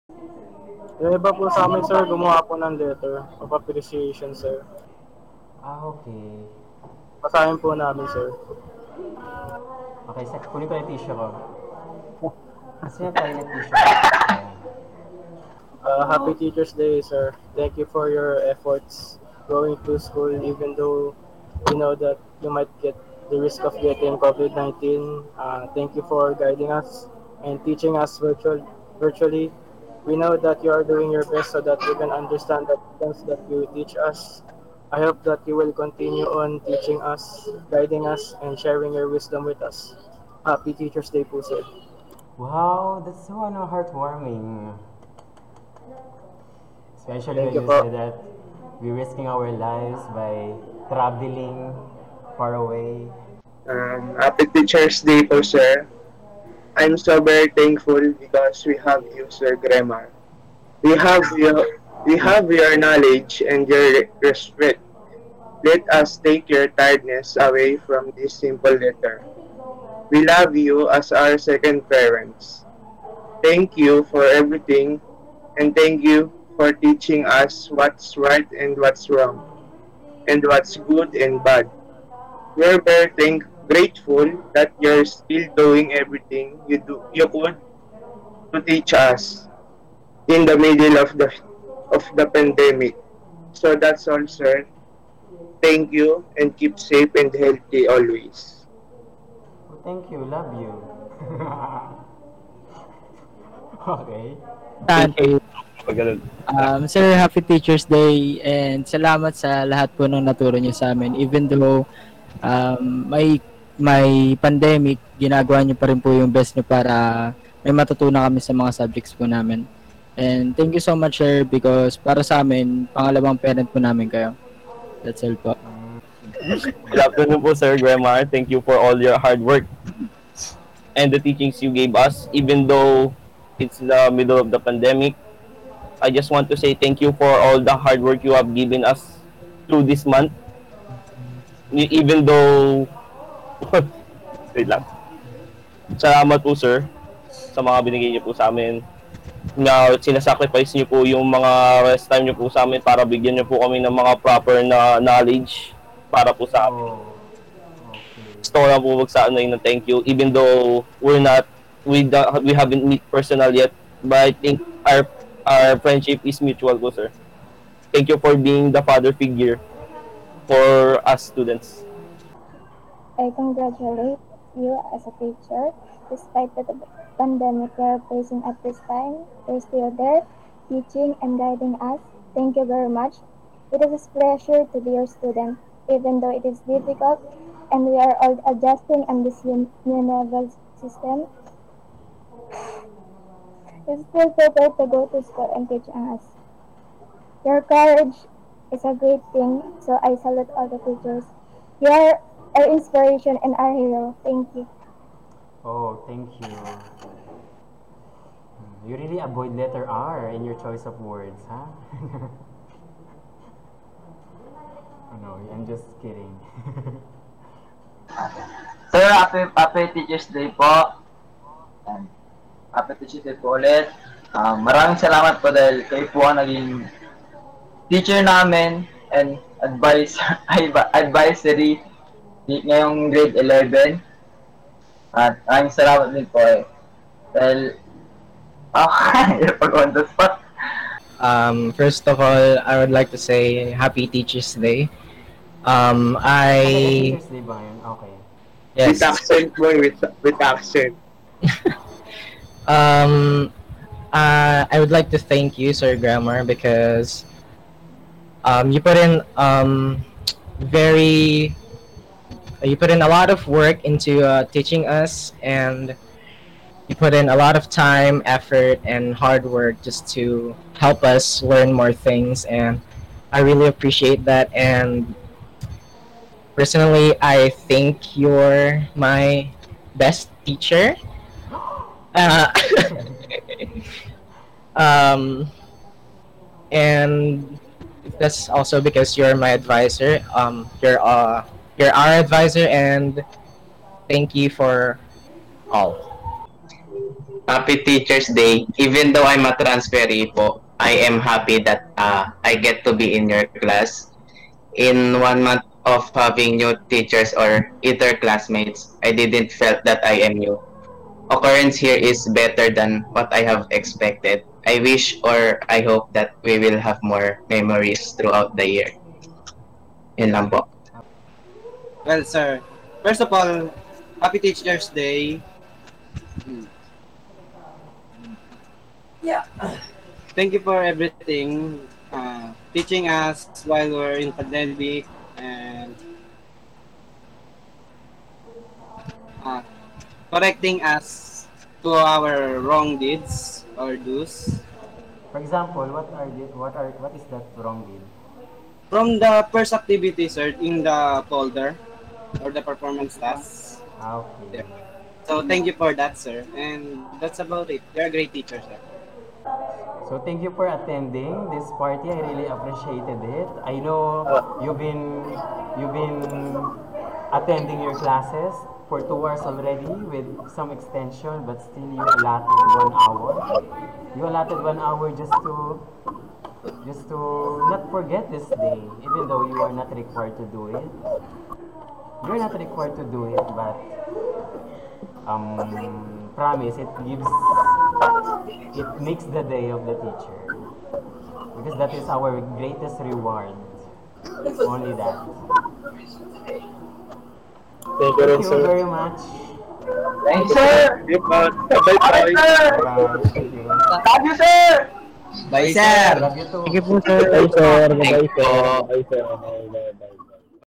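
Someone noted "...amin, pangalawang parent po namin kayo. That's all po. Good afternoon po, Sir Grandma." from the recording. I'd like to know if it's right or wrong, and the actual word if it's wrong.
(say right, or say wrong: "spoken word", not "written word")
right.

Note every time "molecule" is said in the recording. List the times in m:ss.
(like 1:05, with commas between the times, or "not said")
not said.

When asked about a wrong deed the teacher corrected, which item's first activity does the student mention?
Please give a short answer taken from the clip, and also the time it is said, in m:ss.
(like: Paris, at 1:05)
the folder, at 5:50.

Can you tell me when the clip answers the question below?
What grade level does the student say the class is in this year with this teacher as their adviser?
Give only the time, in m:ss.
3:53.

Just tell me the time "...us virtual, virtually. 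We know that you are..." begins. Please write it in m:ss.
0:27.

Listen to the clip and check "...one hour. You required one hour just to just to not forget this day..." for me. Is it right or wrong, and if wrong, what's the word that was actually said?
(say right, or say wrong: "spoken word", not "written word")
wrong: "allotted", not "required".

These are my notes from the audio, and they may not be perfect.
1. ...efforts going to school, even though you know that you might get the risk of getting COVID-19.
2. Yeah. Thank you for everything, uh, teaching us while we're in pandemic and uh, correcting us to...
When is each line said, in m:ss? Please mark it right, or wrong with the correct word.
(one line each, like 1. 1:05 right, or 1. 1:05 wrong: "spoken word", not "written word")
1. 0:18 right
2. 5:29 right.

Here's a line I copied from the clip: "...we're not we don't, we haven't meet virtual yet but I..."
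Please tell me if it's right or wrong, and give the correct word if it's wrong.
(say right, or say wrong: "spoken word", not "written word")
wrong: "personal", not "virtual".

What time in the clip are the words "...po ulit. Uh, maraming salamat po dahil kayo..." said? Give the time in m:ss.
3:43.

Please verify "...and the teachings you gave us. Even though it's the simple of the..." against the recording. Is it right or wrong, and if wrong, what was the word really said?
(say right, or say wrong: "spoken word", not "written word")
wrong: "middle", not "simple".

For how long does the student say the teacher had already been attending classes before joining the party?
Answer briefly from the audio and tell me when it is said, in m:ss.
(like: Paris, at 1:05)
two hours, at 6:09.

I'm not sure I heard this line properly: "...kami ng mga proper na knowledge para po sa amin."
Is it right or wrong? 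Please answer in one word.
right.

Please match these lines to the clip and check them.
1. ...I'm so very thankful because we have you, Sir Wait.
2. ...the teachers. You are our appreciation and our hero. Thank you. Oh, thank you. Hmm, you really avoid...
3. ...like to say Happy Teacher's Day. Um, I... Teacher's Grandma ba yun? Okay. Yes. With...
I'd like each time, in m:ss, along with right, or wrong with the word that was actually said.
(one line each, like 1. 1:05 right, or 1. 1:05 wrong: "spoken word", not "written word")
1. 0:56 wrong: "Gremar", not "Wait"
2. 3:20 wrong: "inspiration", not "appreciation"
3. 4:02 wrong: "Day", not "Grandma".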